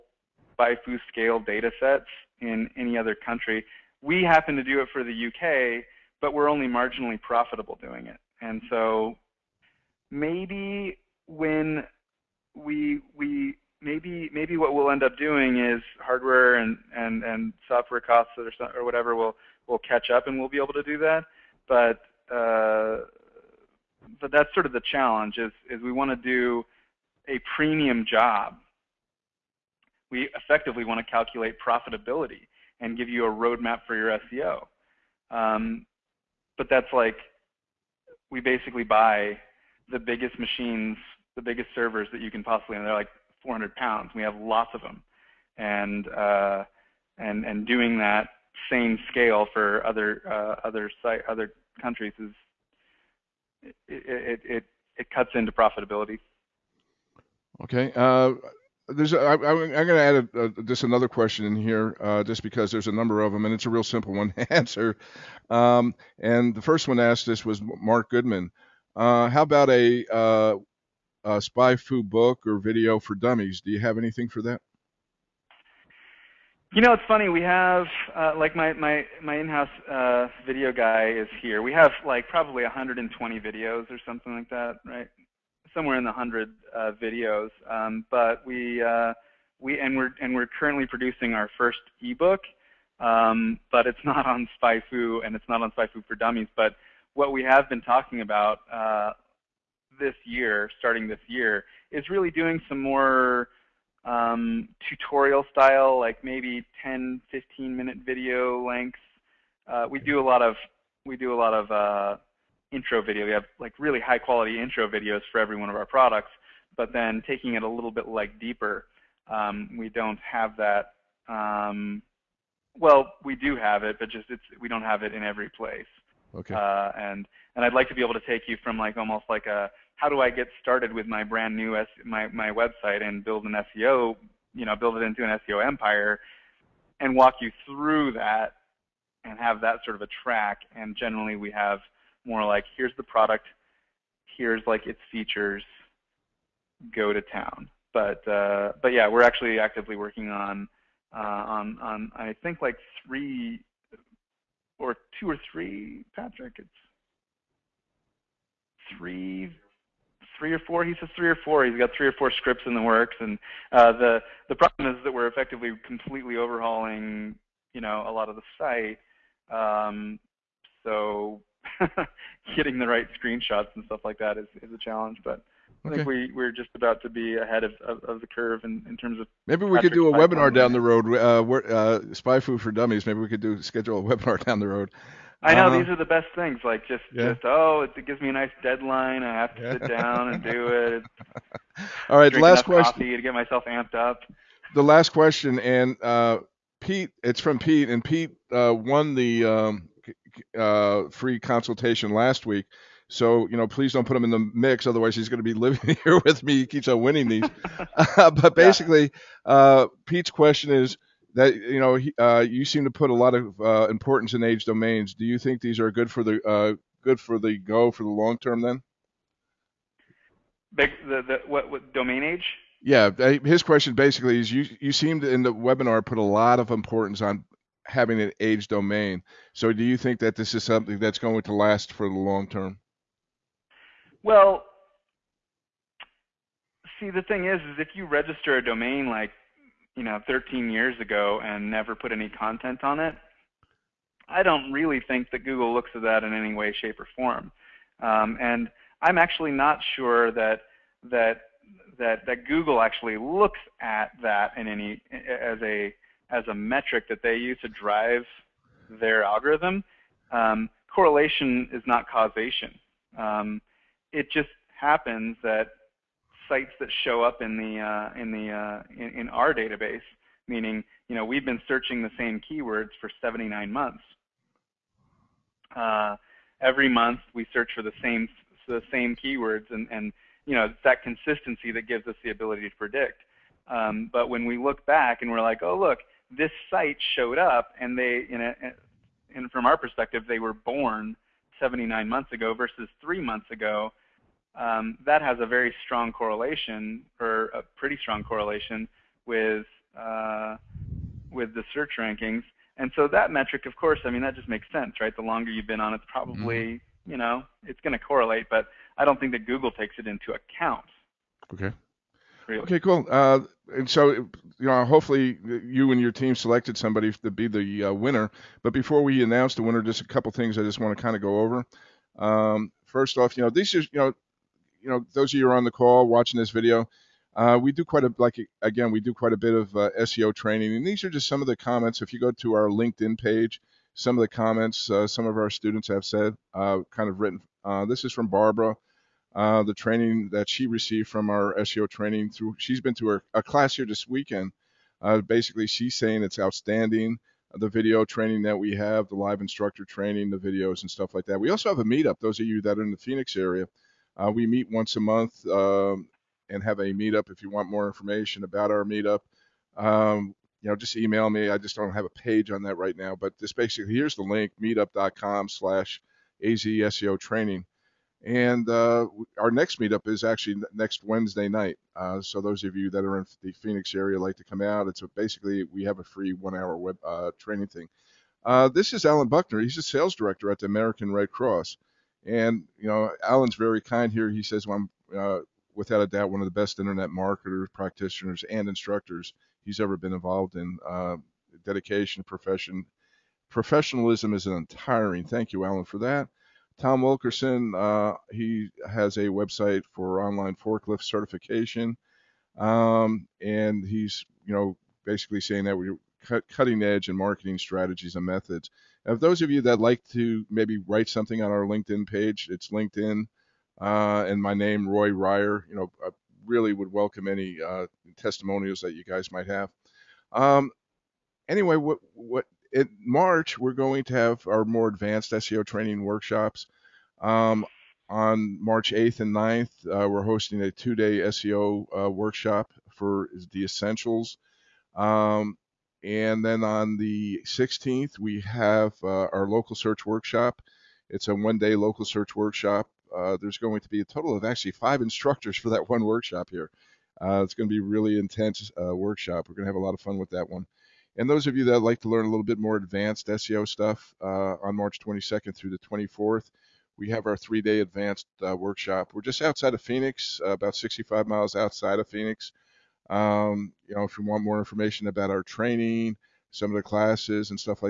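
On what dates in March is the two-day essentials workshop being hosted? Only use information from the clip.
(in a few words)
March 8th and 9th.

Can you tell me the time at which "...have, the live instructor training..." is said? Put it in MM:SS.
05:48.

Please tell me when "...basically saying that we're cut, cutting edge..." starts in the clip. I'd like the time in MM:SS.
06:45.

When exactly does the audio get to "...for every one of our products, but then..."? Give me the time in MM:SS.
01:55.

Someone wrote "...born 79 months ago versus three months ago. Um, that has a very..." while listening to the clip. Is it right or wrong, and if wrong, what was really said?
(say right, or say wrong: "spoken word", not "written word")
right.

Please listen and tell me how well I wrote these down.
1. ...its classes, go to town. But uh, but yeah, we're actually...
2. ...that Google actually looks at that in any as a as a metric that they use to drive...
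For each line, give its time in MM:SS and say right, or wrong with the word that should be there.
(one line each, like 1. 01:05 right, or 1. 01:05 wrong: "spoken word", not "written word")
1. 02:24 wrong: "features", not "classes"
2. 04:12 right.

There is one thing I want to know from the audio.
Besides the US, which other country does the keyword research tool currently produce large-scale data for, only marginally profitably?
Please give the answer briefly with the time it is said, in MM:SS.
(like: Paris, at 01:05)
UK, at 00:05.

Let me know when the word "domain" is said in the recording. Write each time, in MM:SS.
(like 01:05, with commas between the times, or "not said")
03:34, 03:41, 03:48, 03:58.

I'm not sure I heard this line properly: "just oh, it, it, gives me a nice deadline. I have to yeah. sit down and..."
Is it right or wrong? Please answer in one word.
right.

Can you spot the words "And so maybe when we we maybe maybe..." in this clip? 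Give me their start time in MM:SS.
00:08.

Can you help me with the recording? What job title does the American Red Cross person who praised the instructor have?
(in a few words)
Sales director.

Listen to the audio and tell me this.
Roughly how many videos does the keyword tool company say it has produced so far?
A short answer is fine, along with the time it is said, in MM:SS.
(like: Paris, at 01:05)
120, at 01:22.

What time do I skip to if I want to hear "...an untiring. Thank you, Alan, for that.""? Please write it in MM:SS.
06:34.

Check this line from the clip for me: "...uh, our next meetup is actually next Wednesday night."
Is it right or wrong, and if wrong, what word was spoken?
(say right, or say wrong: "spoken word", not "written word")
right.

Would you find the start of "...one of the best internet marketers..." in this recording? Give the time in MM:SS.
06:26.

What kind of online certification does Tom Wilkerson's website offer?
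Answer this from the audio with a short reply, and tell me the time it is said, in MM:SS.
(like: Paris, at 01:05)
Forklift certification, at 06:40.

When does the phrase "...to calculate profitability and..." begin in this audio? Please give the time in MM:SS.
00:31.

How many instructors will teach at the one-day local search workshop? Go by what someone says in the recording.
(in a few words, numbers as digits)
5.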